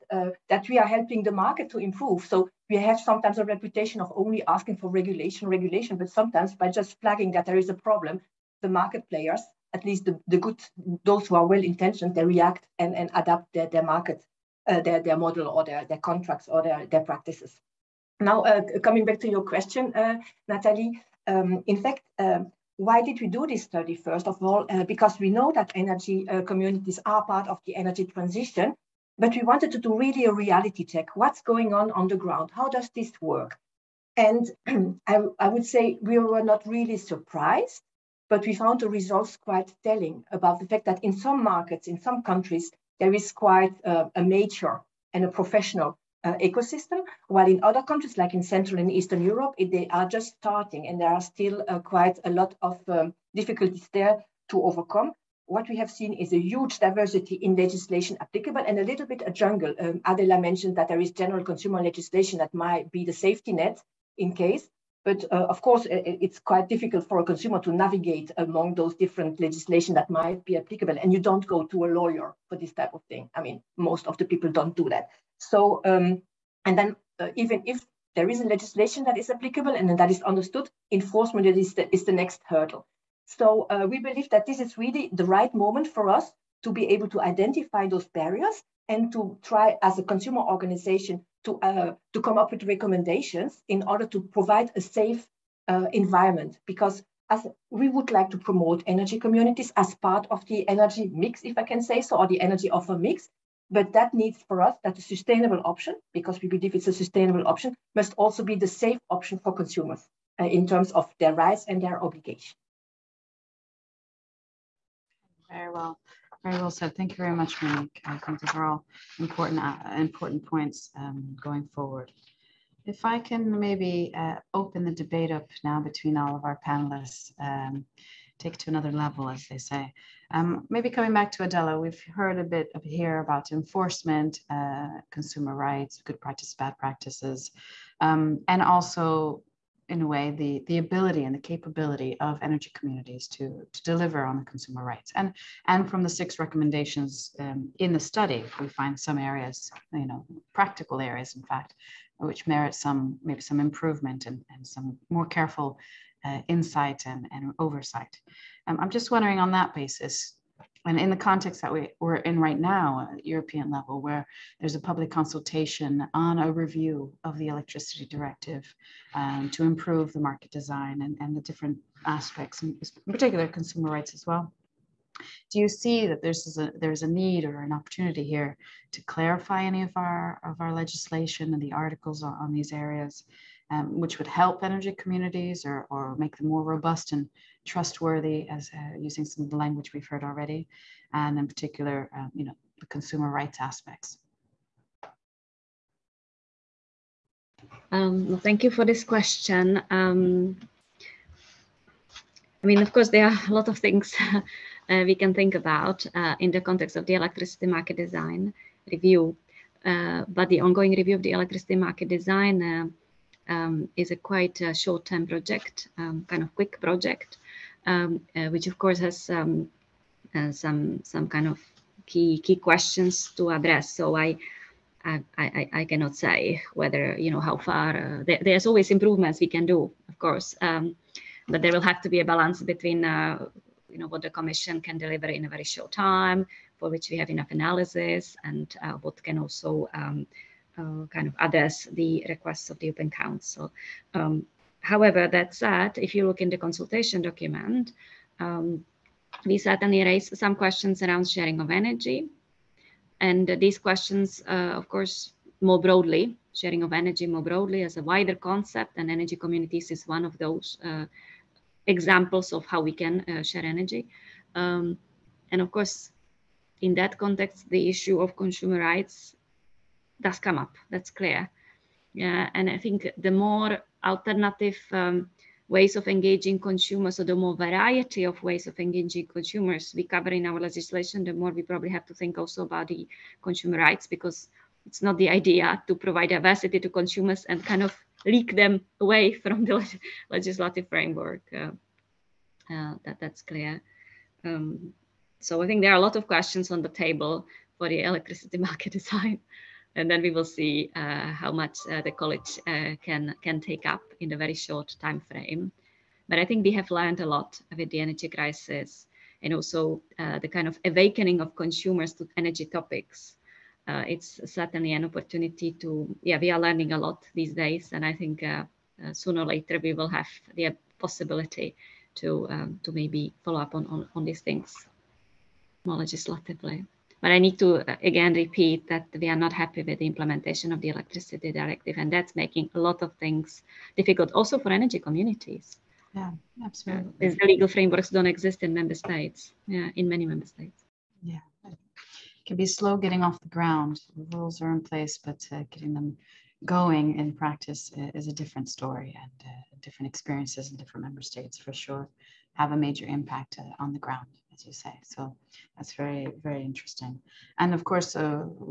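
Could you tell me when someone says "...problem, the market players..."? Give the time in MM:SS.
00:07.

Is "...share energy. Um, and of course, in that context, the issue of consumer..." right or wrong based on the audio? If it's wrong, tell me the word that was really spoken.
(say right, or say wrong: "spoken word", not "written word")
right.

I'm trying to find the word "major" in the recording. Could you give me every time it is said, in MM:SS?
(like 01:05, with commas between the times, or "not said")
00:44, 05:52.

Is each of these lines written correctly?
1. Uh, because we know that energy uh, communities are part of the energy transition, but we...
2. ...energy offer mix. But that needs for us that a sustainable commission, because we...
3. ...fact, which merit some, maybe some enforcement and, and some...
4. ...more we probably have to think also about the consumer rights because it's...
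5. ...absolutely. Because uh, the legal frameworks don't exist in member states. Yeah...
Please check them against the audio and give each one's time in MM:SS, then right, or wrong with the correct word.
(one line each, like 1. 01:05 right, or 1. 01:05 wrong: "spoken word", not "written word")
1. 00:24 right
2. 01:42 wrong: "option", not "commission"
3. 02:31 wrong: "improvement", not "enforcement"
4. 04:41 right
5. 05:36 right.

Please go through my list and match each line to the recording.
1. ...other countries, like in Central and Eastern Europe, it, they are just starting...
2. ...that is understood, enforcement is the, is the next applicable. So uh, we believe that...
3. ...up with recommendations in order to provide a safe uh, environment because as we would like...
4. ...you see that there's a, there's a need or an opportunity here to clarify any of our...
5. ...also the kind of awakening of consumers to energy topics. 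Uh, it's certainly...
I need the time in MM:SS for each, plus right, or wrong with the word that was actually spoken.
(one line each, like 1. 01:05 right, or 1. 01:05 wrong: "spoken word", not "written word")
1. 00:47 right
2. 01:19 wrong: "hurdle", not "applicable"
3. 01:32 right
4. 02:55 right
5. 05:09 right.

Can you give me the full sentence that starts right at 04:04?
Um, however, that said, if you look in the consultation document, um, we certainly raised some questions around sharing of energy.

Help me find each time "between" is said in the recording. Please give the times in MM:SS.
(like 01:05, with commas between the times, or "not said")
02:05, 03:52.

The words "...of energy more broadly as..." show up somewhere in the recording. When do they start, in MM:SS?
04:16.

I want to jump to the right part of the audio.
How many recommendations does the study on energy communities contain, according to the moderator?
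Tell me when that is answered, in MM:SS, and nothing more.
02:26.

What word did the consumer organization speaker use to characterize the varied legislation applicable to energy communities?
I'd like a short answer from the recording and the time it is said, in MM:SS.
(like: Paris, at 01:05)
a jungle, at 00:59.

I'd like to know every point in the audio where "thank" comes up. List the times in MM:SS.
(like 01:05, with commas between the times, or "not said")
01:56, 03:18.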